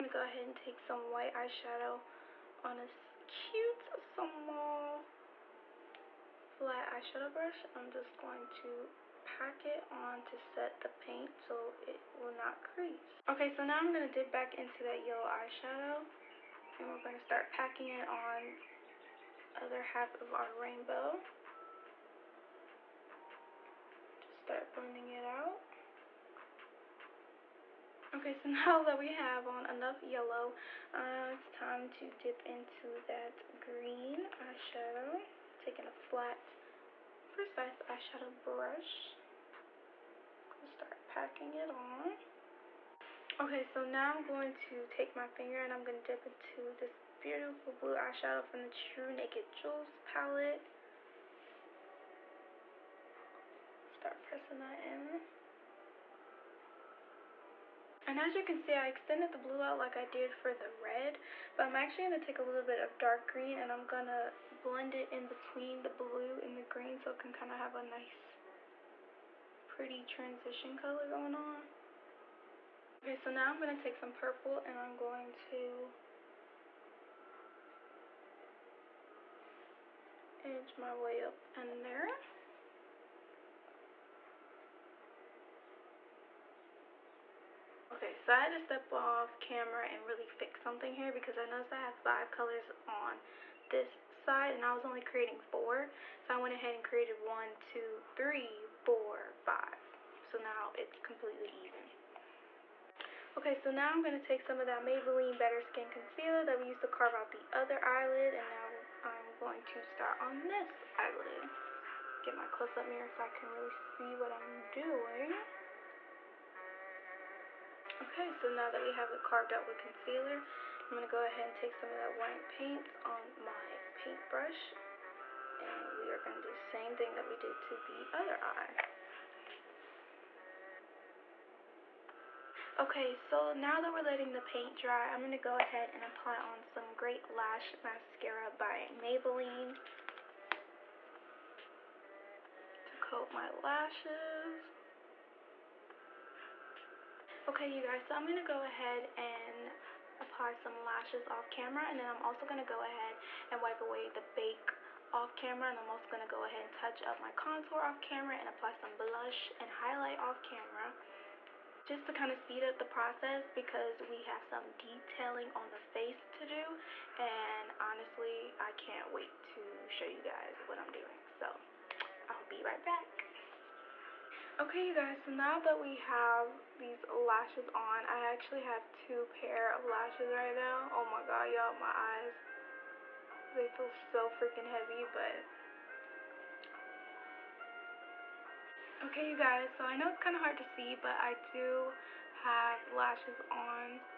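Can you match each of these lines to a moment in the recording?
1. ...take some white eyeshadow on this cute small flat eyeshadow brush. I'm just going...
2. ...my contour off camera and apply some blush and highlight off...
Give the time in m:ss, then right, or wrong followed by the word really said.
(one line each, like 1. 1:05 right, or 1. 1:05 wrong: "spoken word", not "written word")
1. 0:00 right
2. 2:37 right.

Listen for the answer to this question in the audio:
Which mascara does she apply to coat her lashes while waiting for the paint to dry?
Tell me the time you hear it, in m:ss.
2:16.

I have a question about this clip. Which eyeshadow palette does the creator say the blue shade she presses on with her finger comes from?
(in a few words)
True Naked Jewels.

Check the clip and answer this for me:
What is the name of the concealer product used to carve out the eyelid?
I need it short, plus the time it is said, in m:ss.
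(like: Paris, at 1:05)
Maybelline Better Skin Concealer, at 1:44.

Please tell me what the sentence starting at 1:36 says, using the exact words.
So I went ahead and created one, two, three, four, five.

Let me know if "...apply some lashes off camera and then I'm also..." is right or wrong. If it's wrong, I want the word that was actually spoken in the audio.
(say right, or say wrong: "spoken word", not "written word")
right.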